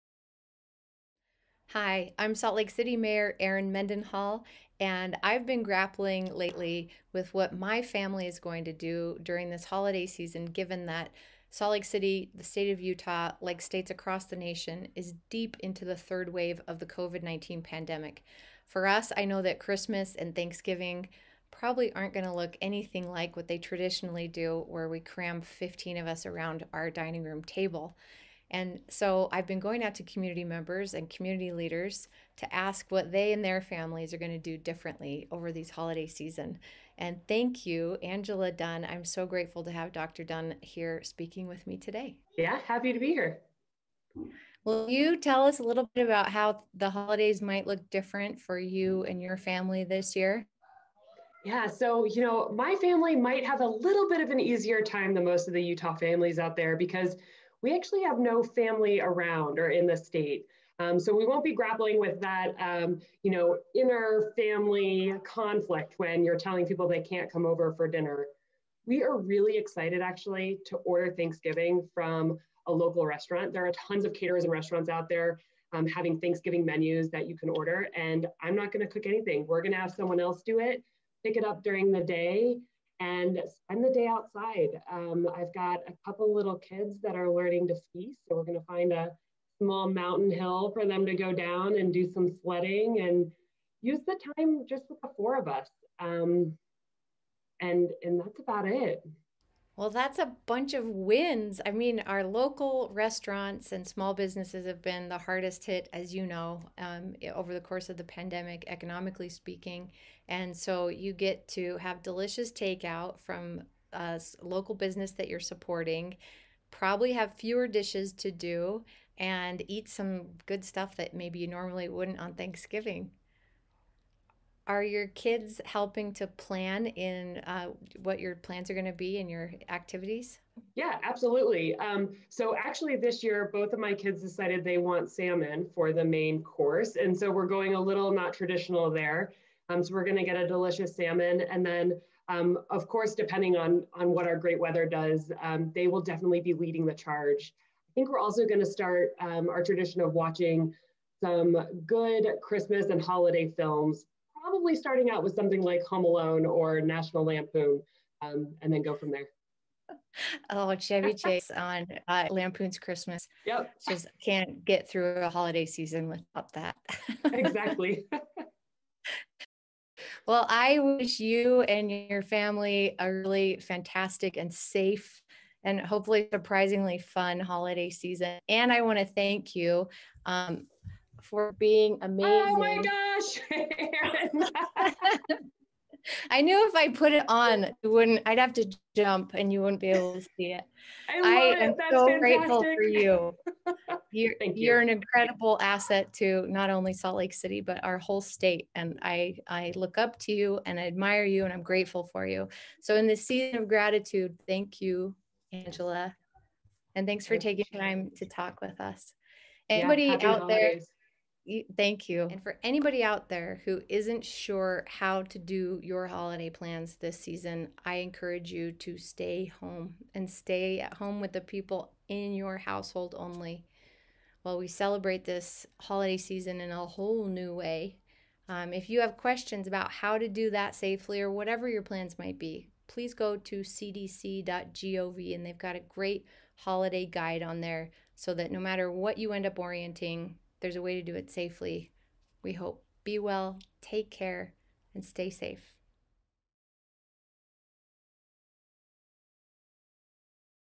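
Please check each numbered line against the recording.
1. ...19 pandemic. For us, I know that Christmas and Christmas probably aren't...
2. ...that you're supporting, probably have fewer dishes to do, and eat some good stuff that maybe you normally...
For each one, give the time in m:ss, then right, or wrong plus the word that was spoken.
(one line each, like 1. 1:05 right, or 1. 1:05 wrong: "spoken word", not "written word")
1. 0:17 wrong: "Thanksgiving", not "Christmas"
2. 1:55 right.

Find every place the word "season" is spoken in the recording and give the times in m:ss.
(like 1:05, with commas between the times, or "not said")
0:10, 0:36, 2:45, 2:57, 3:23, 3:37, 3:46.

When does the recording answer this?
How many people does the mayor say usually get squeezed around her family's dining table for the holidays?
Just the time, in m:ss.
0:25.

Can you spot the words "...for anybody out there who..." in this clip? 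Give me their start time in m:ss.
3:32.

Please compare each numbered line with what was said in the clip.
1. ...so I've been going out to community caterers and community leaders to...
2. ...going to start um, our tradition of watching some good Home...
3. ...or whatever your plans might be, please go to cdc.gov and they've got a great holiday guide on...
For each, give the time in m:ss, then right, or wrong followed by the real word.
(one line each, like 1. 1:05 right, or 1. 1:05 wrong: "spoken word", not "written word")
1. 0:28 wrong: "members", not "caterers"
2. 2:28 wrong: "Christmas", not "Home"
3. 3:51 right.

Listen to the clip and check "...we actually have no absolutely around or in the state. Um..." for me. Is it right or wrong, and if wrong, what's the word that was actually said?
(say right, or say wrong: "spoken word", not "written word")
wrong: "family", not "absolutely".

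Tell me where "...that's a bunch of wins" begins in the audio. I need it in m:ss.
1:39.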